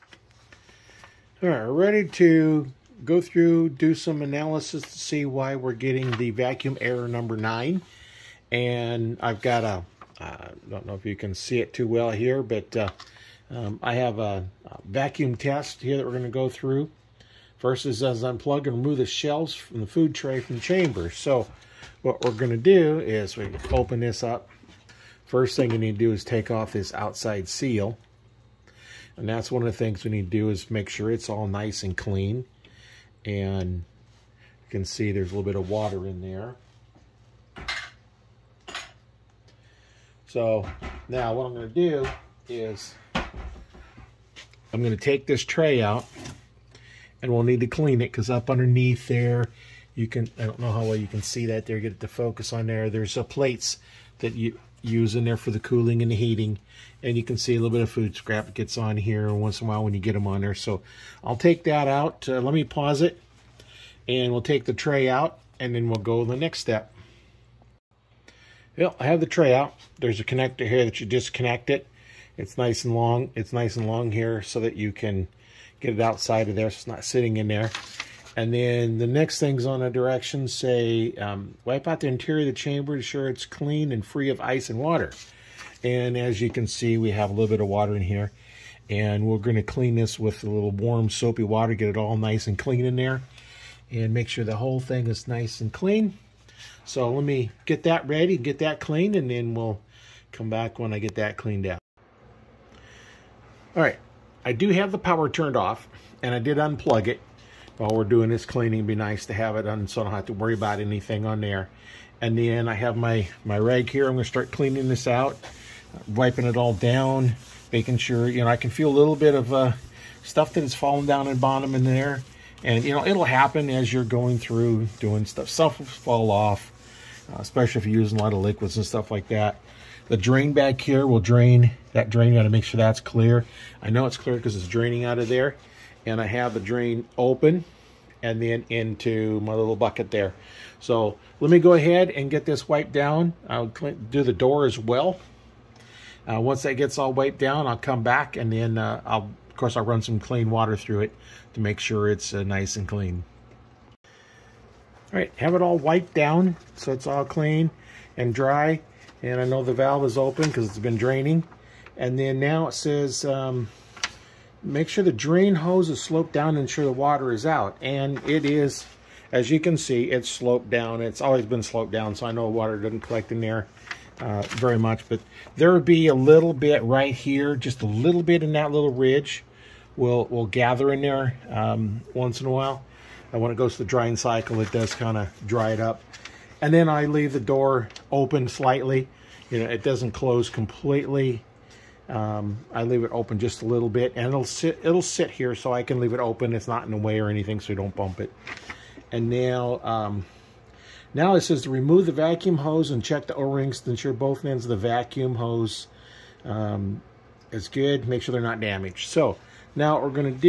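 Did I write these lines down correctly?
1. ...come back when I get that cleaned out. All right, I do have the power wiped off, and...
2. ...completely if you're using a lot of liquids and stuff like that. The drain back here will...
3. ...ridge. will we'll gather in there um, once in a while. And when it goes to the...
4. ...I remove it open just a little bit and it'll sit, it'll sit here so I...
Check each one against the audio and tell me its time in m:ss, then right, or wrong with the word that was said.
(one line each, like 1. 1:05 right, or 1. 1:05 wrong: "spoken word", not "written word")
1. 1:40 wrong: "turned", not "wiped"
2. 2:07 wrong: "especially", not "completely"
3. 2:58 right
4. 3:12 wrong: "leave", not "remove".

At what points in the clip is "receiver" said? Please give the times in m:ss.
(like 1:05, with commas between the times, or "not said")
not said.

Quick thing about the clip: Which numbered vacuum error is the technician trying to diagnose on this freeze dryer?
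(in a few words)
9.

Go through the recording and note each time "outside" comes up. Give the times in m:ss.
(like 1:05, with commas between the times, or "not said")
0:26, 1:16.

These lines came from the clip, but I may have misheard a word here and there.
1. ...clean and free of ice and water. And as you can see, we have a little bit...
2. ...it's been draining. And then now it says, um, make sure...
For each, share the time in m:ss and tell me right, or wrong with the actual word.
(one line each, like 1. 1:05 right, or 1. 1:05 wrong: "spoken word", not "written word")
1. 1:23 right
2. 2:40 right.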